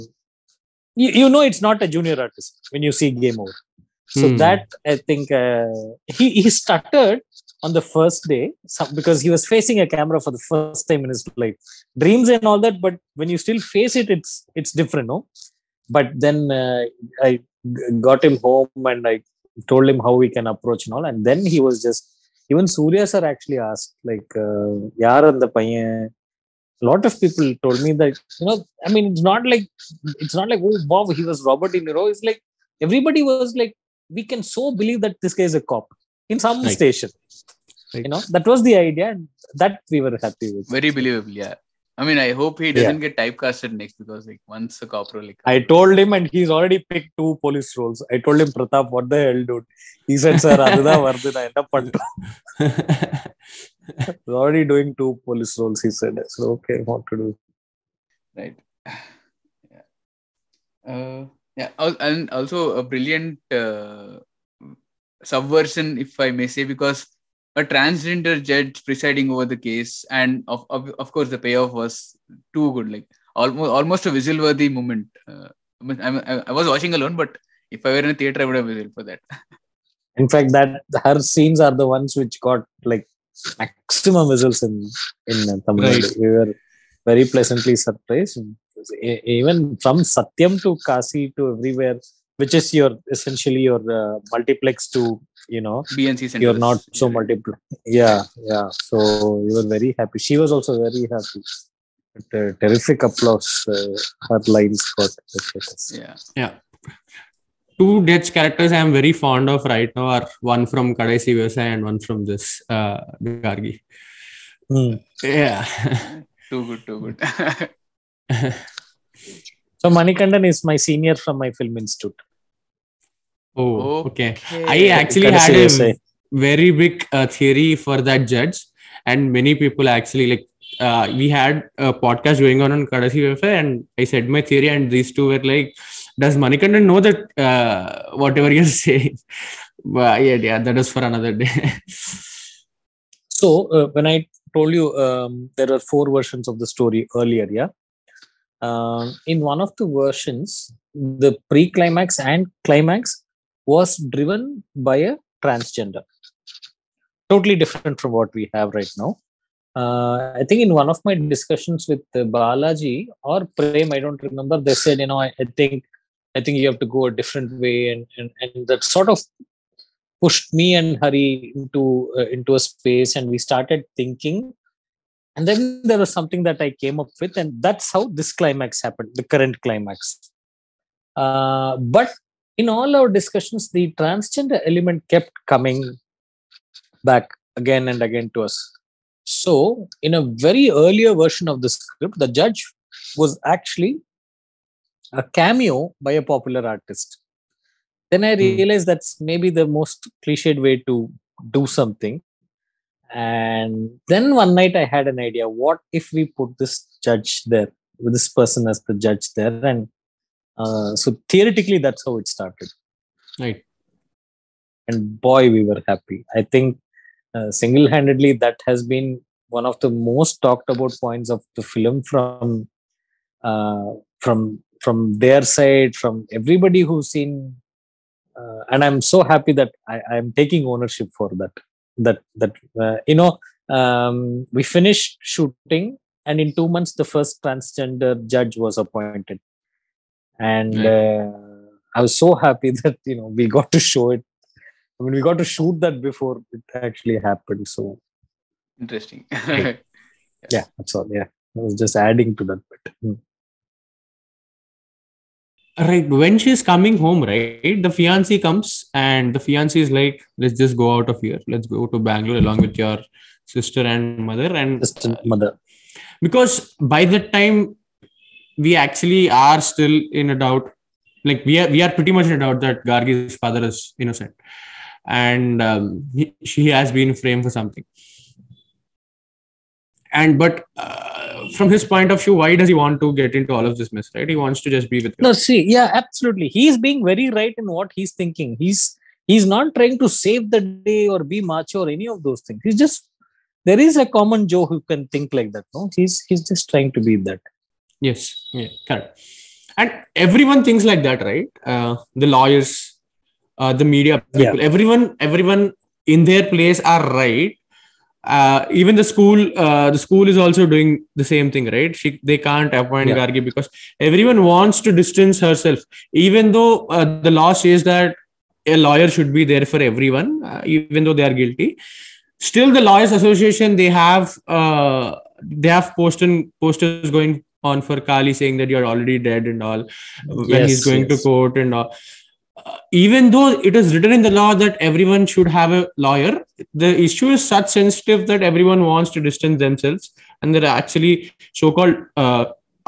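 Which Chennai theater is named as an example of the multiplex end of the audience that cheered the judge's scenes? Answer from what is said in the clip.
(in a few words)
Satyam.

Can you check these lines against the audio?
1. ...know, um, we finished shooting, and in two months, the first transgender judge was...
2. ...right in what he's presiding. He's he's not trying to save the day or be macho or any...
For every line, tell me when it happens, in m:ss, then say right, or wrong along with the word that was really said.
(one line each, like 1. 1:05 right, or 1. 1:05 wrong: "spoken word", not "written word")
1. 3:53 right
2. 4:47 wrong: "thinking", not "presiding".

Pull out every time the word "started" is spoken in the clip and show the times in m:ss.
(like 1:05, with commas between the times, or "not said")
2:53, 3:32.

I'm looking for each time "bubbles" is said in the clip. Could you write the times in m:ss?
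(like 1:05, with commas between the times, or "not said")
not said.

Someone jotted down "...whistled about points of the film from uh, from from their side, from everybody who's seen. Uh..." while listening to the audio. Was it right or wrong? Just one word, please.
wrong.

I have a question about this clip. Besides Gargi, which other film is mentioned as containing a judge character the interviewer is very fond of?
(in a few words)
Kadaisi Vivasayi.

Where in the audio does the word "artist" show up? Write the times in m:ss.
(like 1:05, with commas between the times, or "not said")
0:02, 3:16.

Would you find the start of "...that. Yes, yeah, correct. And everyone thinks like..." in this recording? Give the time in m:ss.
4:57.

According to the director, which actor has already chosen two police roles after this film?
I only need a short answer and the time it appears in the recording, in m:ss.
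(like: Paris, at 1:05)
Pratap, at 0:48.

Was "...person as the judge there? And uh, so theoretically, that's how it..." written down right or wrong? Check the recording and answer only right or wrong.
right.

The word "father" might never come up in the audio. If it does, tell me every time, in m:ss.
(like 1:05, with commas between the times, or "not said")
4:33.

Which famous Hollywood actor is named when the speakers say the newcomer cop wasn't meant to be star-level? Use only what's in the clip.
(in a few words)
Robert De Niro.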